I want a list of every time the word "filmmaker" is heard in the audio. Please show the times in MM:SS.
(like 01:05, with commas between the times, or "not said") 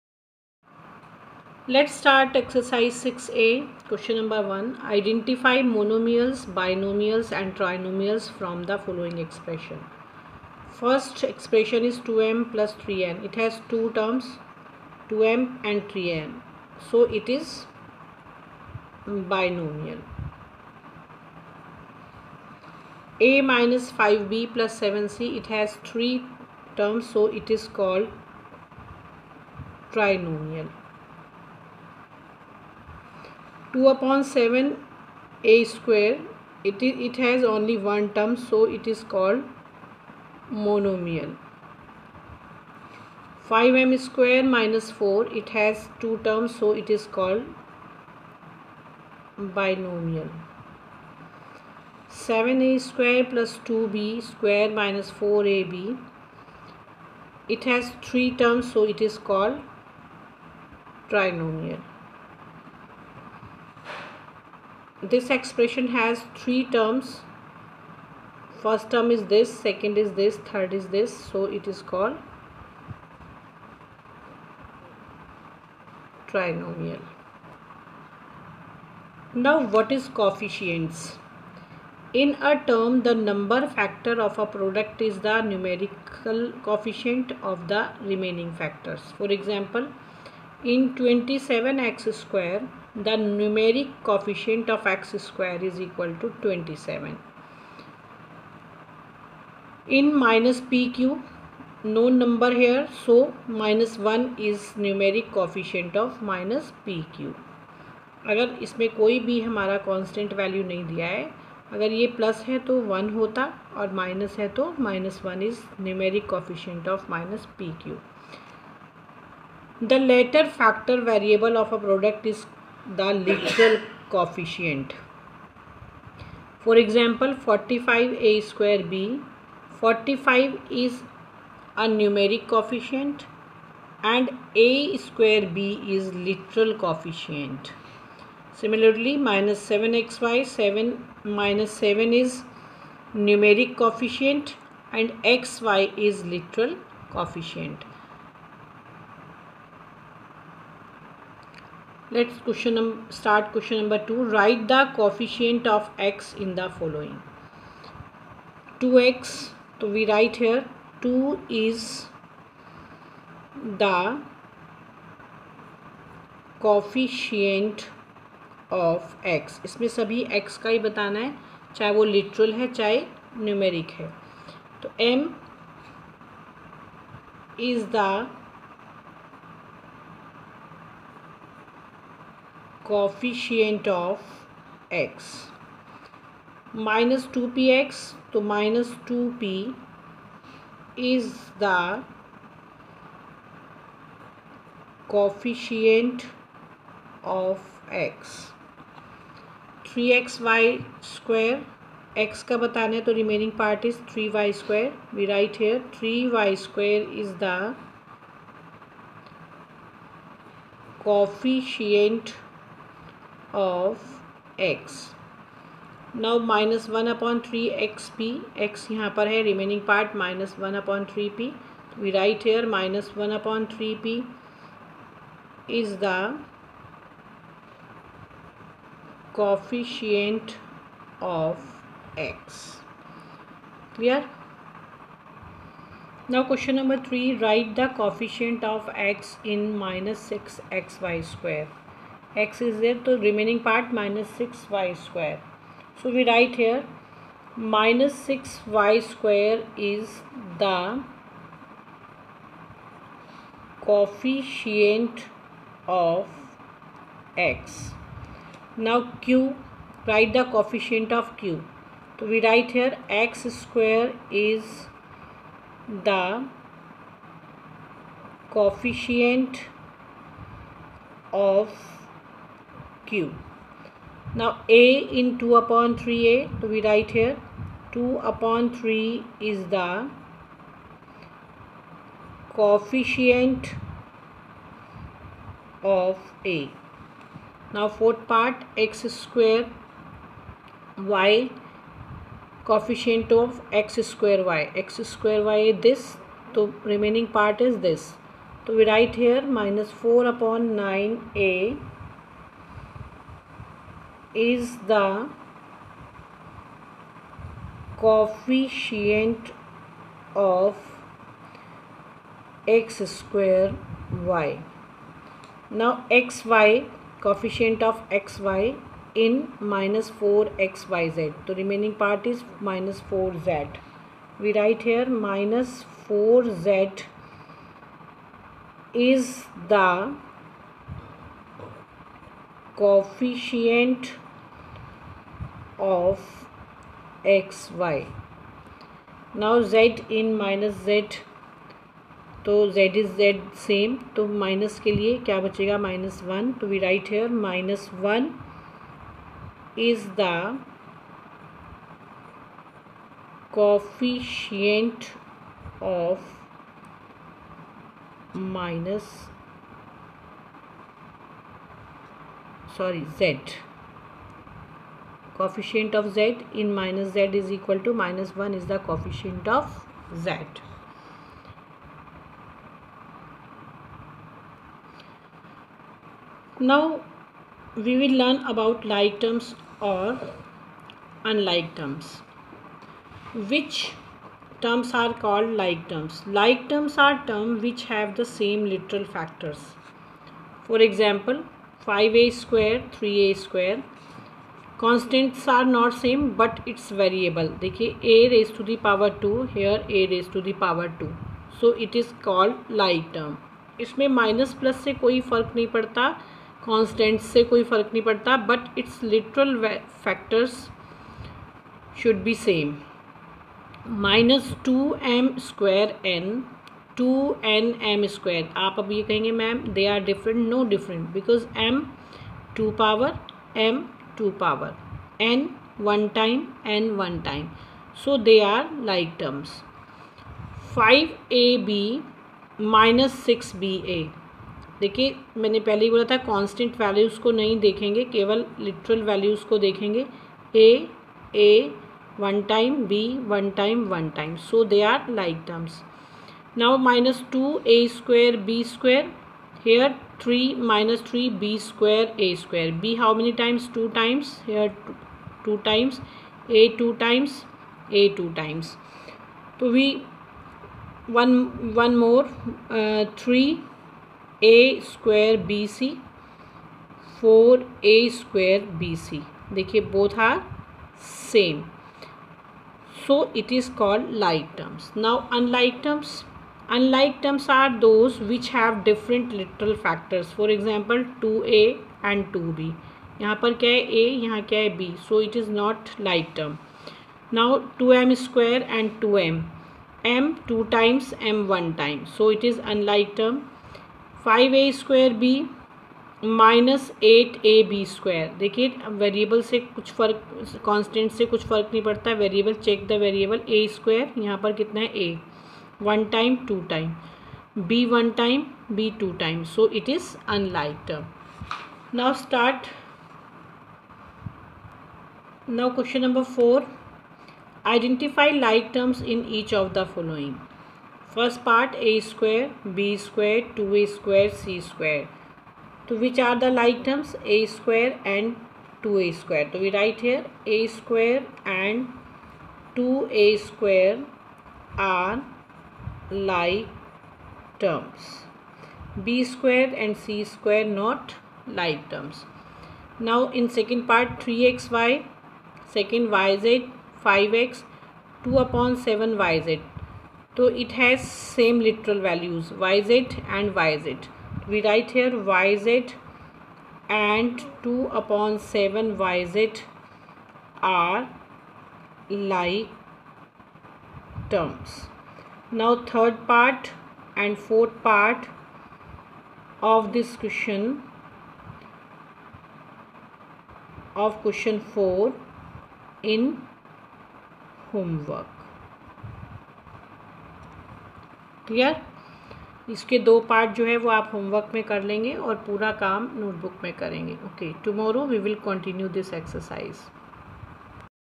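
not said.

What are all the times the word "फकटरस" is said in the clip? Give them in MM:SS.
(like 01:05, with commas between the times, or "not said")
06:50, 07:59.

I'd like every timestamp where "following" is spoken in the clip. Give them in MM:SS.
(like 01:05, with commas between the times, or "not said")
00:08, 08:39.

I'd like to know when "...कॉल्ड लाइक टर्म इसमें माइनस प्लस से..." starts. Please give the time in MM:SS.
06:42.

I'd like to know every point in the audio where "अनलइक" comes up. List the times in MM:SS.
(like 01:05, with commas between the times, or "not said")
07:56, 08:12.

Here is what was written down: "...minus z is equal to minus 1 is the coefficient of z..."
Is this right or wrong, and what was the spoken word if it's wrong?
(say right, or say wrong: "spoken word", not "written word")
right.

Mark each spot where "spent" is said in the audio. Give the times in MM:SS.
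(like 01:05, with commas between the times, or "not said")
not said.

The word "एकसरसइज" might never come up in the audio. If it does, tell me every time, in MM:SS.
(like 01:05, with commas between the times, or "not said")
09:49.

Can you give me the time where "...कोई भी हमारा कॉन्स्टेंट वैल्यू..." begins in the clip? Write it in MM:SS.
01:48.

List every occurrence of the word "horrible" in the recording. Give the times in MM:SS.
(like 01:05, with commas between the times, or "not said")
not said.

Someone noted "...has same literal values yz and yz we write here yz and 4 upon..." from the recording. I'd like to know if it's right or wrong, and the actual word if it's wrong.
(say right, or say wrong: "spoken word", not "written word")
wrong: "2", not "4".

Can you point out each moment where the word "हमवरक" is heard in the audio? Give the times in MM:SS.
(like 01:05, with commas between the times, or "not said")
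09:37, 09:44.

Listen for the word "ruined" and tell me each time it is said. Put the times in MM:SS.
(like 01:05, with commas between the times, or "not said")
not said.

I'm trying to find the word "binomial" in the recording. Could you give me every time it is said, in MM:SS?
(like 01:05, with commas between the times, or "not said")
00:06, 00:19, 00:49.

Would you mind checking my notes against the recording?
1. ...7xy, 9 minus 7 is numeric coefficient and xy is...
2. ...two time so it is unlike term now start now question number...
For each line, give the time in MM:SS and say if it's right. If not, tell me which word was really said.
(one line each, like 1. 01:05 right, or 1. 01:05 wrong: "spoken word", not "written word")
1. 02:19 wrong: "7", not "9"
2. 08:29 right.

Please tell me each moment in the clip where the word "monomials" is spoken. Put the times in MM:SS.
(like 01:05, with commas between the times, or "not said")
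00:05, 00:40.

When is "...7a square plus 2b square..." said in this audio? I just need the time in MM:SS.
00:52.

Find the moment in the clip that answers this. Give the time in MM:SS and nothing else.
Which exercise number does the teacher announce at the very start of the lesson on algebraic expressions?
00:02.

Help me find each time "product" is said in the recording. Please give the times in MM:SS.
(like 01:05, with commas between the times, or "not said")
01:24, 02:01.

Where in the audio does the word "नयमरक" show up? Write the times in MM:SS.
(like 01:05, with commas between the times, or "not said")
01:33, 01:44, 01:55, 02:53.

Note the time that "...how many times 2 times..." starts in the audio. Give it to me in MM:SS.
07:32.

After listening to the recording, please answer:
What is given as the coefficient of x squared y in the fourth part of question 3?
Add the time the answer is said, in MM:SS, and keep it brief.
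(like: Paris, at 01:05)
-4/9 a, at 04:59.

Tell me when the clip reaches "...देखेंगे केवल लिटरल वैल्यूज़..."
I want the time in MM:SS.
07:17.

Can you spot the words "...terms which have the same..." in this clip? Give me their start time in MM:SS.
06:27.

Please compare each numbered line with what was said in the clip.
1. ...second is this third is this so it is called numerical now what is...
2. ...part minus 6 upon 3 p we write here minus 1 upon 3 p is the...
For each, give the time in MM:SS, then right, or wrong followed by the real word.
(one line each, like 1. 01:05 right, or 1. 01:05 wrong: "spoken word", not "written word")
1. 01:09 wrong: "trinomial", not "numerical"
2. 03:39 wrong: "1", not "6".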